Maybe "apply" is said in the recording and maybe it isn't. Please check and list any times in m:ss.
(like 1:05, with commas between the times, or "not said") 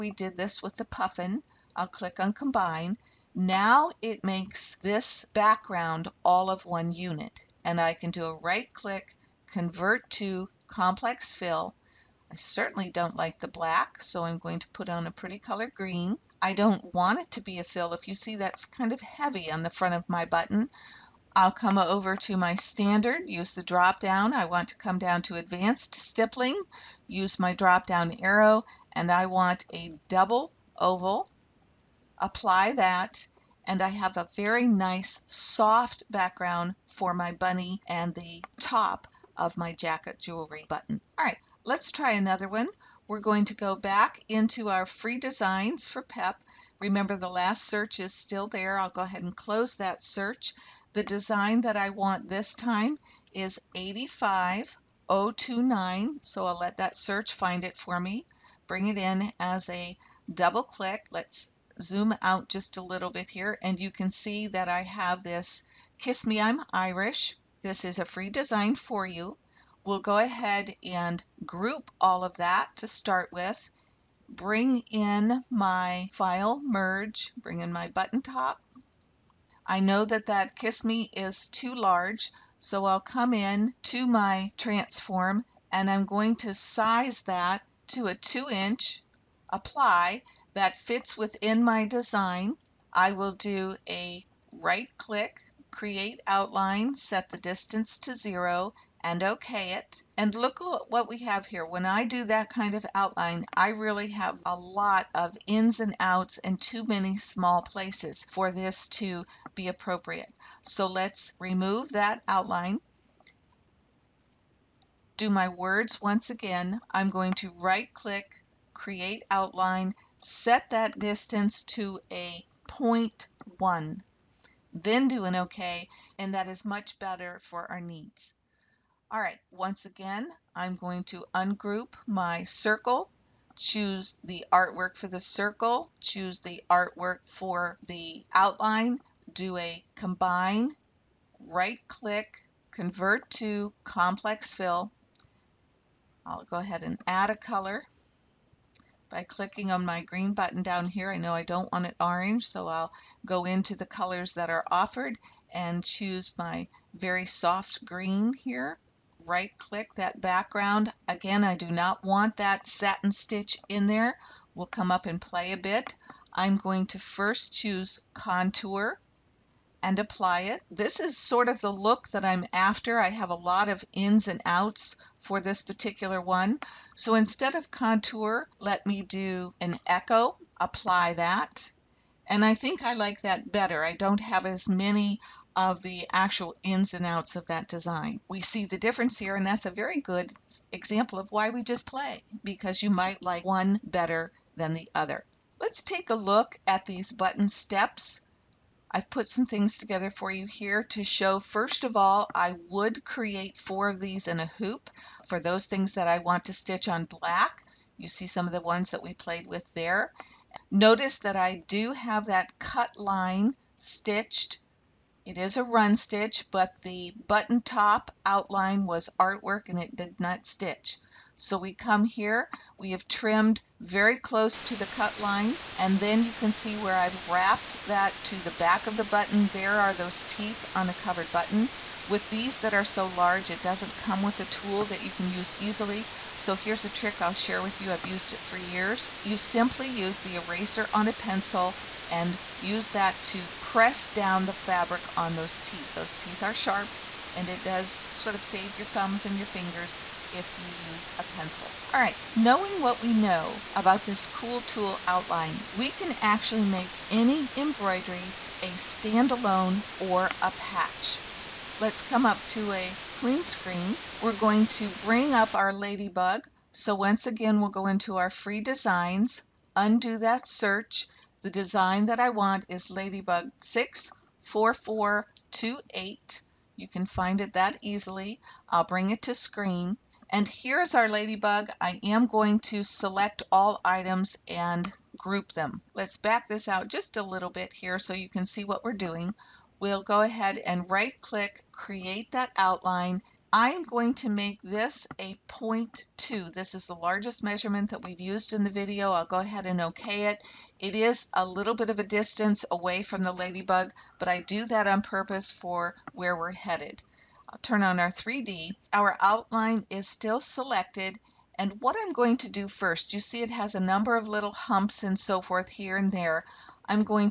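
0:32, 1:29, 2:49, 3:00.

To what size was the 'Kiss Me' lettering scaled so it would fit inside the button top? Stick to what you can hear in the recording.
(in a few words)
2 inch.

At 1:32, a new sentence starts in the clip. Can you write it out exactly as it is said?
I will do a right click, create outline, set the distance to zero, and okay it.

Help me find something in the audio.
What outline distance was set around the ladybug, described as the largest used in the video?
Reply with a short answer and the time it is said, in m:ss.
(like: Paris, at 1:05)
0.2, at 4:55.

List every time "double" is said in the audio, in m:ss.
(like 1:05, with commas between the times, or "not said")
0:30, 1:00.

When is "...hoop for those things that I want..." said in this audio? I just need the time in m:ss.
3:24.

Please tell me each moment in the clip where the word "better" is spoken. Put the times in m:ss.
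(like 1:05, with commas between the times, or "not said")
2:06, 3:03, 3:13.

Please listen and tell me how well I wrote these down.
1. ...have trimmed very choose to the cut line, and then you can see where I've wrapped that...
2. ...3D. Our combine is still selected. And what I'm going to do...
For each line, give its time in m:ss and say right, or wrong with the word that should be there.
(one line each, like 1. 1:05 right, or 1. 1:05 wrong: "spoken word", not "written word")
1. 3:42 wrong: "close", not "choose"
2. 5:08 wrong: "outline", not "combine".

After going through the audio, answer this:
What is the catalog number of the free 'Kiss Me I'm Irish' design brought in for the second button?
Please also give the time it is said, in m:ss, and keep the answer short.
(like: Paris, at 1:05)
85029, at 0:53.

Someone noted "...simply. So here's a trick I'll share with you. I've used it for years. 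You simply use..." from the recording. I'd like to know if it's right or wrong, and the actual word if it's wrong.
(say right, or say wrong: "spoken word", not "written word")
wrong: "easily", not "simply".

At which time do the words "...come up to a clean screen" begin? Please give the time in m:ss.
4:22.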